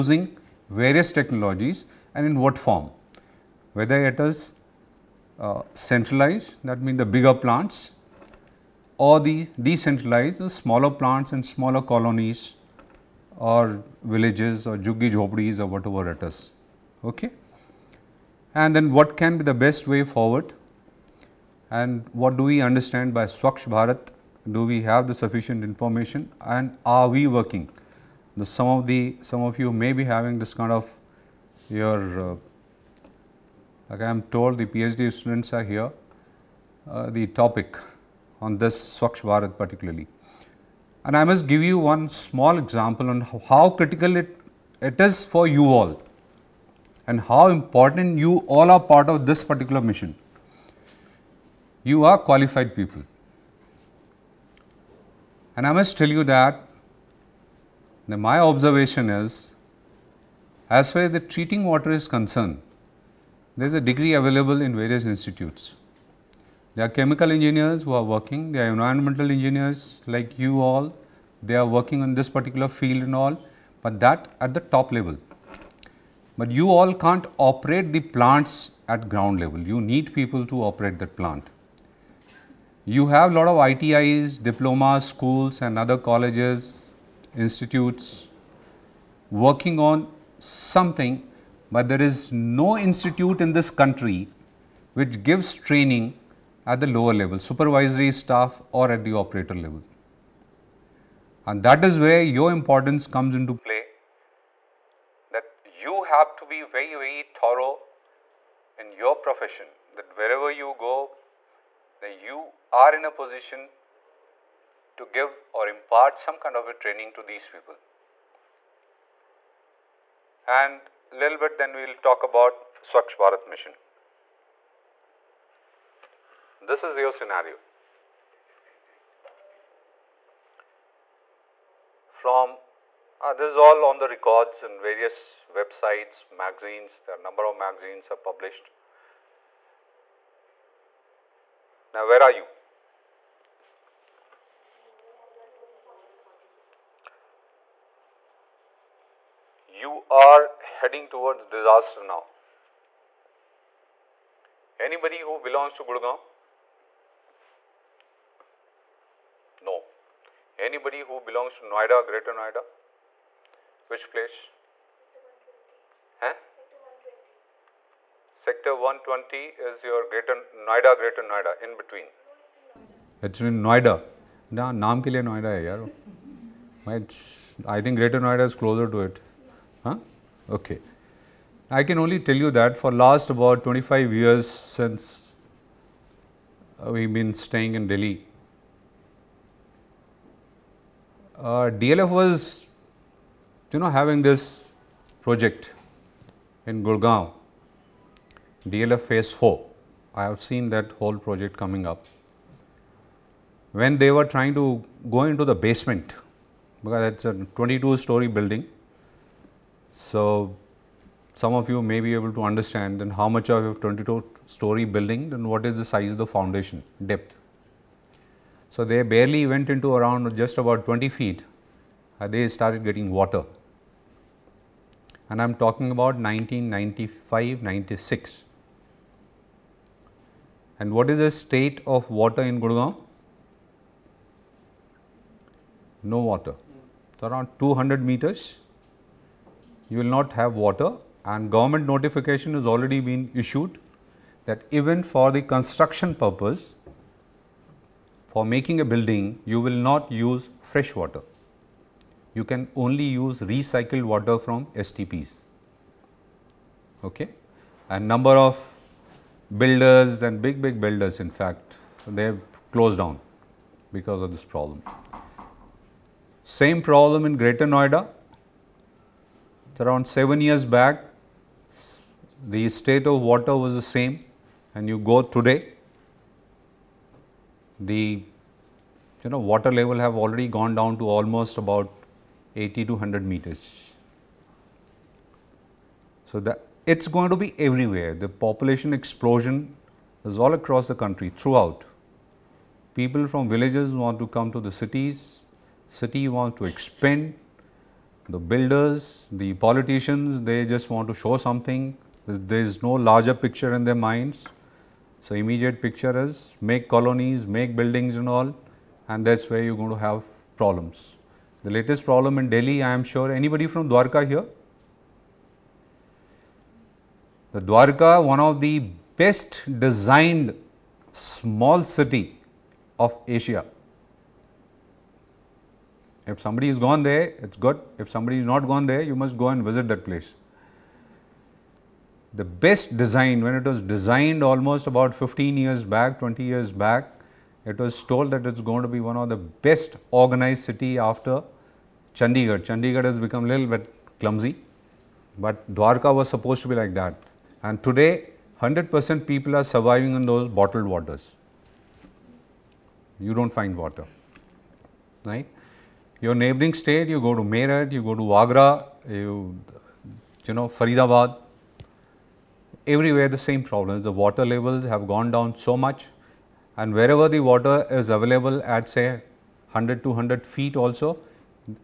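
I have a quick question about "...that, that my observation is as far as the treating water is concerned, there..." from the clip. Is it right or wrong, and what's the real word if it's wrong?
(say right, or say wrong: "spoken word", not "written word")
right.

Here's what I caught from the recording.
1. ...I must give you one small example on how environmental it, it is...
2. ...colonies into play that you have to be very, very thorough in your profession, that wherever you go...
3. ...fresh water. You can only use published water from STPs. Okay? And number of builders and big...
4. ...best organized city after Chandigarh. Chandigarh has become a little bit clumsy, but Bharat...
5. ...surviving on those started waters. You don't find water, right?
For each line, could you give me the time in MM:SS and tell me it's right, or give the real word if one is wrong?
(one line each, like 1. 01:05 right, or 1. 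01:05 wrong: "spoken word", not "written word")
1. 00:41 wrong: "critical", not "environmental"
2. 01:43 wrong: "comes", not "colonies"
3. 04:10 wrong: "recycled", not "published"
4. 05:39 wrong: "Dwarka", not "Bharat"
5. 05:49 wrong: "bottled", not "started".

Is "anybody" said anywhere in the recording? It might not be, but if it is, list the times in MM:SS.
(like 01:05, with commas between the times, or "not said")
02:34, 02:40, 05:13.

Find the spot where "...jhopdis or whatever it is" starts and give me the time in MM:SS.
00:15.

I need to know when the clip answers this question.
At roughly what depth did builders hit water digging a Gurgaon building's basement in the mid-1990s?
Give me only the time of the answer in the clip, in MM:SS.
03:40.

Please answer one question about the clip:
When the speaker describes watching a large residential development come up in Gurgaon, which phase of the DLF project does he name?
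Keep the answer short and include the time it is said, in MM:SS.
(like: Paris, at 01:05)
DLF phase 4, at 03:18.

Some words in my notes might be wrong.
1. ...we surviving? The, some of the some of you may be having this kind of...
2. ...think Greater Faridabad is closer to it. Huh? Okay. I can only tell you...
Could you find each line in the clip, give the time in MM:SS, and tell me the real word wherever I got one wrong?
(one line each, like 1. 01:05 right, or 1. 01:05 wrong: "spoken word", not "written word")
1. 00:27 wrong: "working", not "surviving"
2. 02:57 wrong: "Noida", not "Faridabad".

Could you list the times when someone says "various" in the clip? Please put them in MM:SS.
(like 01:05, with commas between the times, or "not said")
00:00, 01:04, 02:14.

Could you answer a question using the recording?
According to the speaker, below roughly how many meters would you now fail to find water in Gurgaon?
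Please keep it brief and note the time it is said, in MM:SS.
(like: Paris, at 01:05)
200 meters, at 03:57.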